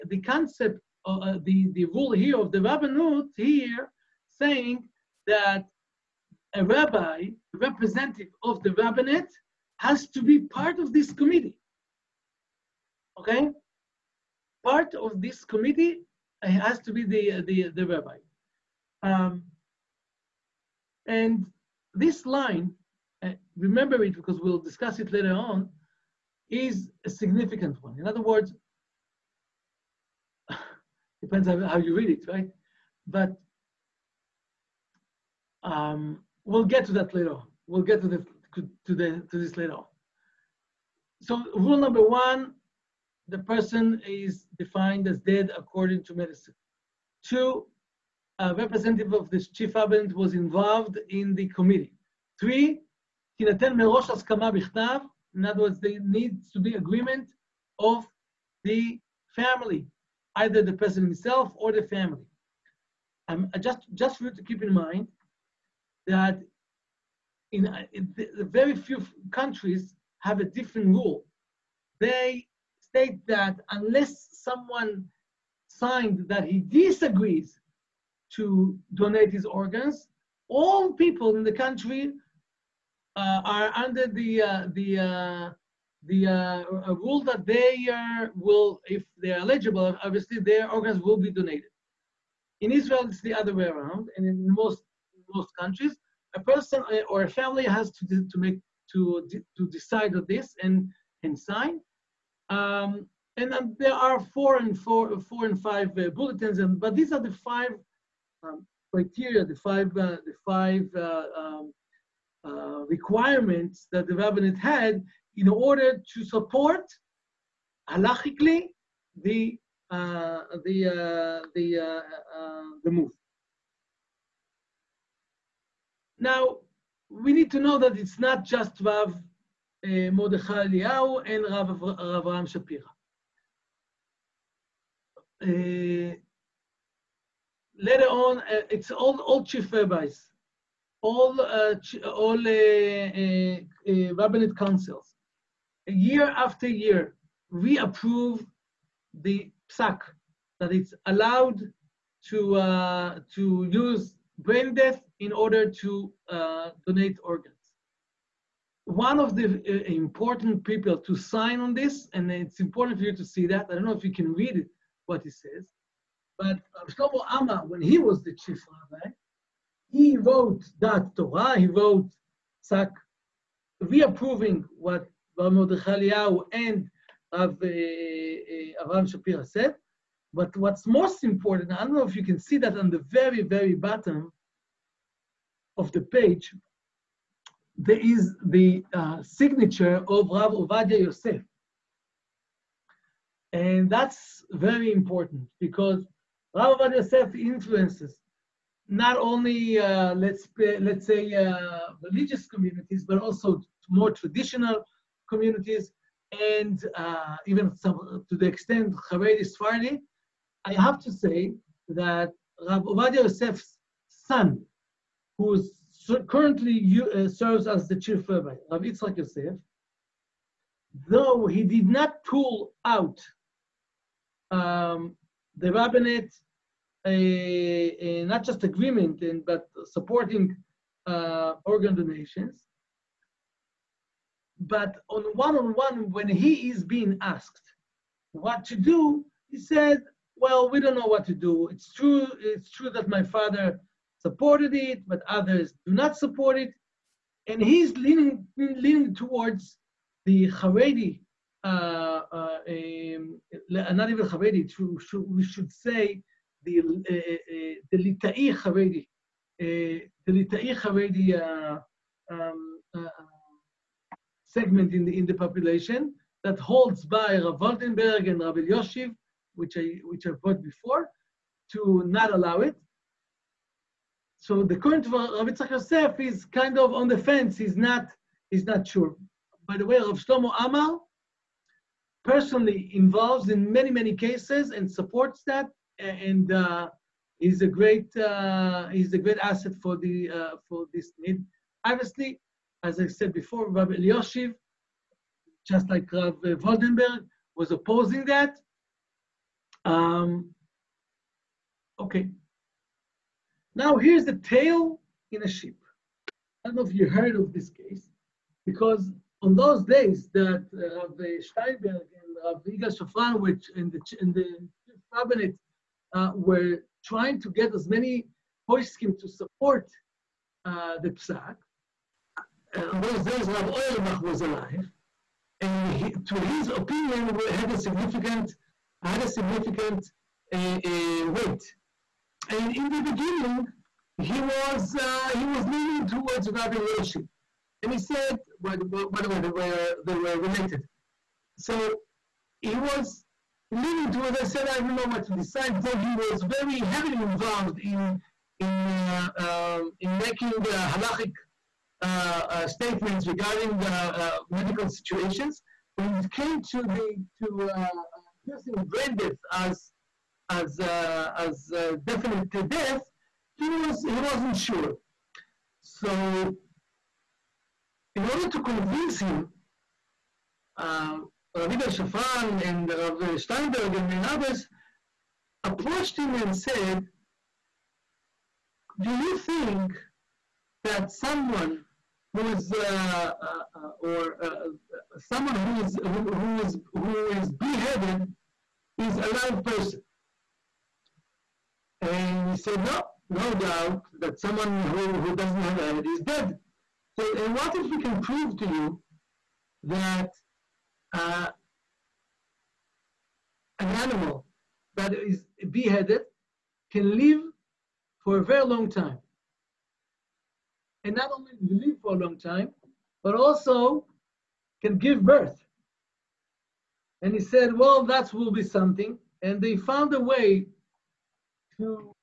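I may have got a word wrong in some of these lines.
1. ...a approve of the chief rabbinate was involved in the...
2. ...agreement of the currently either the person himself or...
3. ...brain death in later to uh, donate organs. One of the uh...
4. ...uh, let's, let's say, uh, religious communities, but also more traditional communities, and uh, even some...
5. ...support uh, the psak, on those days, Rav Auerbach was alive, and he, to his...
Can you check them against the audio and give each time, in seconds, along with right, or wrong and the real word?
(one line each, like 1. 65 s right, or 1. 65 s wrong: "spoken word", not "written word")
1. 48 s wrong: "representative", not "approve"
2. 56 s wrong: "family", not "currently"
3. 154 s wrong: "order", not "later"
4. 199 s right
5. 319 s right.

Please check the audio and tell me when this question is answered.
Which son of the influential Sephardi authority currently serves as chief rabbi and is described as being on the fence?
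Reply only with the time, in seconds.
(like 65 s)
218 s.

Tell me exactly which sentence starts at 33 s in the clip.
But um, we'll get to that later.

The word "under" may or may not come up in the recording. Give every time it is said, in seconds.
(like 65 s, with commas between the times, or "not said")
83 s.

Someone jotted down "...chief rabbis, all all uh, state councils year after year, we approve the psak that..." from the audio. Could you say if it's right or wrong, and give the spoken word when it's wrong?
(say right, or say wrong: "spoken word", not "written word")
wrong: "rabbinate", not "state".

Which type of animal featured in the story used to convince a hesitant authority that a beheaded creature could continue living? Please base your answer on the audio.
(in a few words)
sheep.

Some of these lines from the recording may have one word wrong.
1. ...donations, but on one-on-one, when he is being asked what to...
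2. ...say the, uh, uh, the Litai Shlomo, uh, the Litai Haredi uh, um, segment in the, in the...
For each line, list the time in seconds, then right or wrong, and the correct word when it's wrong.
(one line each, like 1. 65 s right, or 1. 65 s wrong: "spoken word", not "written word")
1. 231 s right
2. 255 s wrong: "Haredi", not "Shlomo".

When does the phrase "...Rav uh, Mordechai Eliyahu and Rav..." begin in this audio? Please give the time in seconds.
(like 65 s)
128 s.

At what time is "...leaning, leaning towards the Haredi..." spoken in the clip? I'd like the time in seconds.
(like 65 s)
247 s.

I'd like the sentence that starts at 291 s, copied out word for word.
Obviously, as I said before, Rabbi Elyashiv, just like Rav Waldenberg, was opposing that.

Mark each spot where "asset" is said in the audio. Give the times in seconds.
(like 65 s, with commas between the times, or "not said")
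289 s.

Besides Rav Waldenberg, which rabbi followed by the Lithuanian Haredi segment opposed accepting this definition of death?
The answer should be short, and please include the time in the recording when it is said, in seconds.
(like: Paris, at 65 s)
Rav Elyashiv, at 268 s.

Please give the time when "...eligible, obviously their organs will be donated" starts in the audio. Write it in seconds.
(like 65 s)
89 s.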